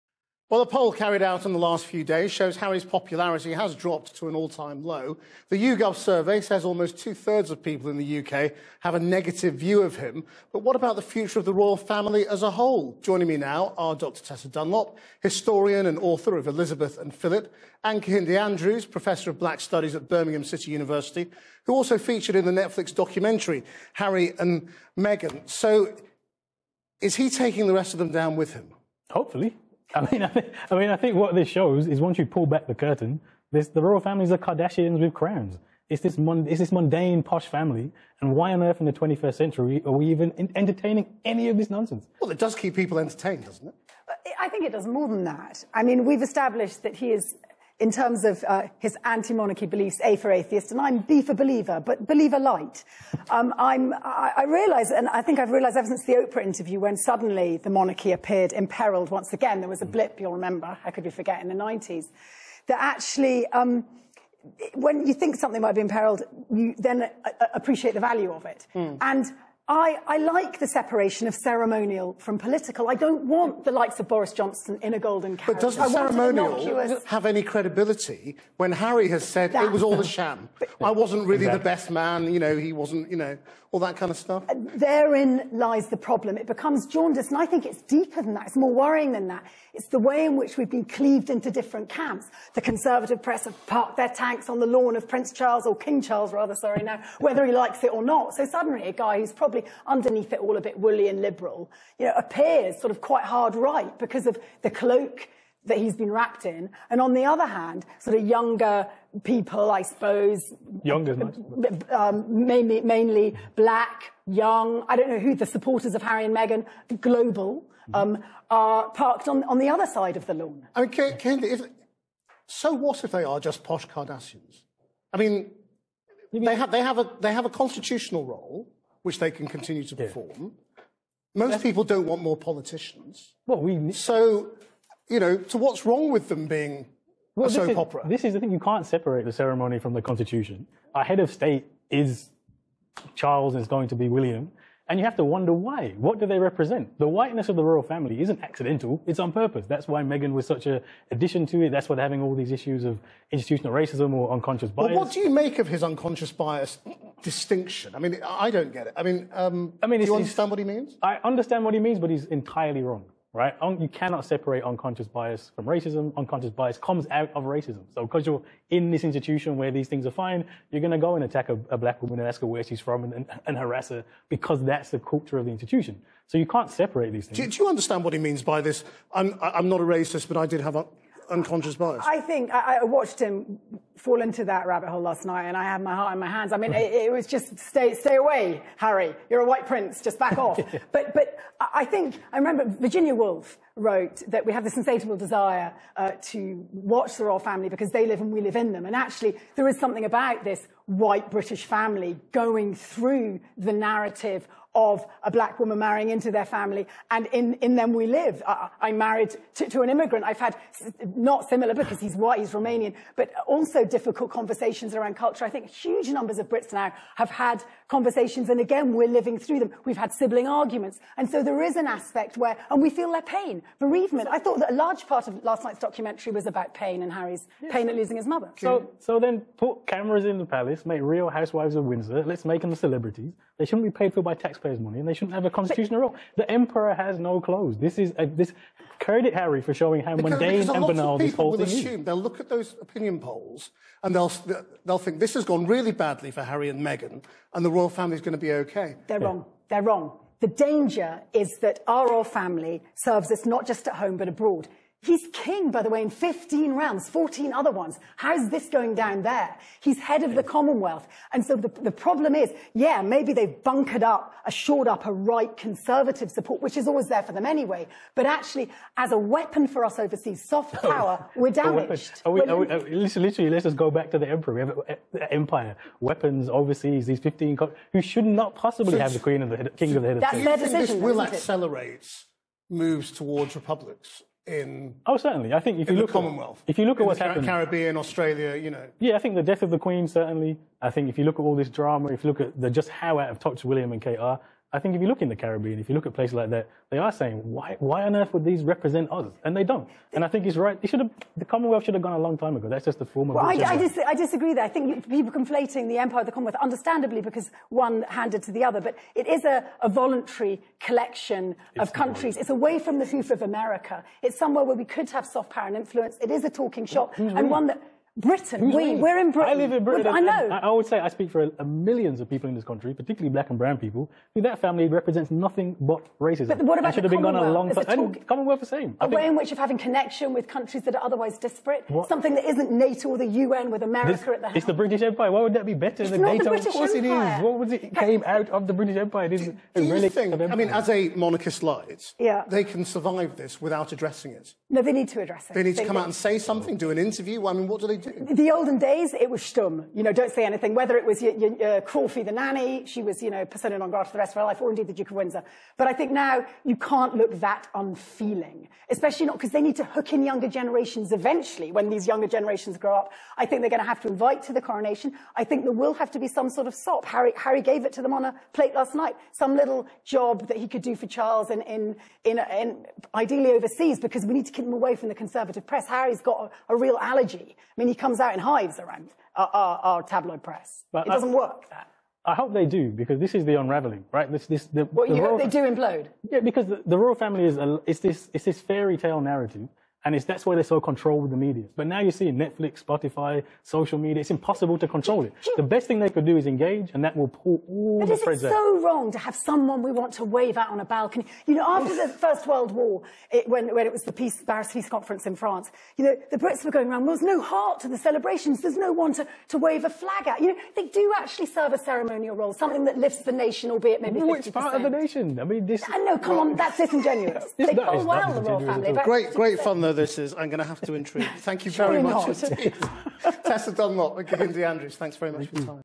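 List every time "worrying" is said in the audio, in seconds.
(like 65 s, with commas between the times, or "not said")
88 s.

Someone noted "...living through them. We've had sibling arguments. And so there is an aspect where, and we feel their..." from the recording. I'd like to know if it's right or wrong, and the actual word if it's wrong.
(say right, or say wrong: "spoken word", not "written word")
right.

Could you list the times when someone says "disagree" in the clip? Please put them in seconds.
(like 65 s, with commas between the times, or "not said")
304 s.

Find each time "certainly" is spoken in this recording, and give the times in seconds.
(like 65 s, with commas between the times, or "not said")
285 s, 290 s.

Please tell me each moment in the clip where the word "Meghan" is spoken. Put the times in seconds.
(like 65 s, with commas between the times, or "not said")
24 s, 116 s, 150 s, 246 s.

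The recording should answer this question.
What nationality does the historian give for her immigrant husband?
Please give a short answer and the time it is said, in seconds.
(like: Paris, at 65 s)
Romanian, at 212 s.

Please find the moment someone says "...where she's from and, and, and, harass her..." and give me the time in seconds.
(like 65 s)
172 s.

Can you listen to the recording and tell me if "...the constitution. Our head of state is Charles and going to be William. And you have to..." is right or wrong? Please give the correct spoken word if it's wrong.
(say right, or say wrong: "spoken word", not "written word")
right.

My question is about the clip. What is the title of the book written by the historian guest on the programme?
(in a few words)
Elizabeth and Philip.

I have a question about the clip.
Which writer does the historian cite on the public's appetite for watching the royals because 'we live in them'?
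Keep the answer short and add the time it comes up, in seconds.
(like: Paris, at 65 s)
Virginia Woolf, at 192 s.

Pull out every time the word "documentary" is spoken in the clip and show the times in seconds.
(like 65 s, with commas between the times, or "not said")
22 s, 225 s.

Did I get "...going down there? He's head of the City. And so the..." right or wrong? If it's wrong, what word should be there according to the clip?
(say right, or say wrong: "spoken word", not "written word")
wrong: "Commonwealth", not "City".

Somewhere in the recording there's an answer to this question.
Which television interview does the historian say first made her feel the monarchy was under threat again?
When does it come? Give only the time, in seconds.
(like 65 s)
56 s.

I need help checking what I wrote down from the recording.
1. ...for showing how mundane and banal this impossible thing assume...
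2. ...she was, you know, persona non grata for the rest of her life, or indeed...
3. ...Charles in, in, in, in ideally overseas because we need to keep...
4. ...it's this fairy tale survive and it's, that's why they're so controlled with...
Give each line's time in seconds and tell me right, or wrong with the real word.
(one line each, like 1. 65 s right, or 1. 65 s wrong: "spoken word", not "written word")
1. 239 s wrong: "whole", not "impossible"
2. 352 s right
3. 371 s right
4. 388 s wrong: "narrative", not "survive".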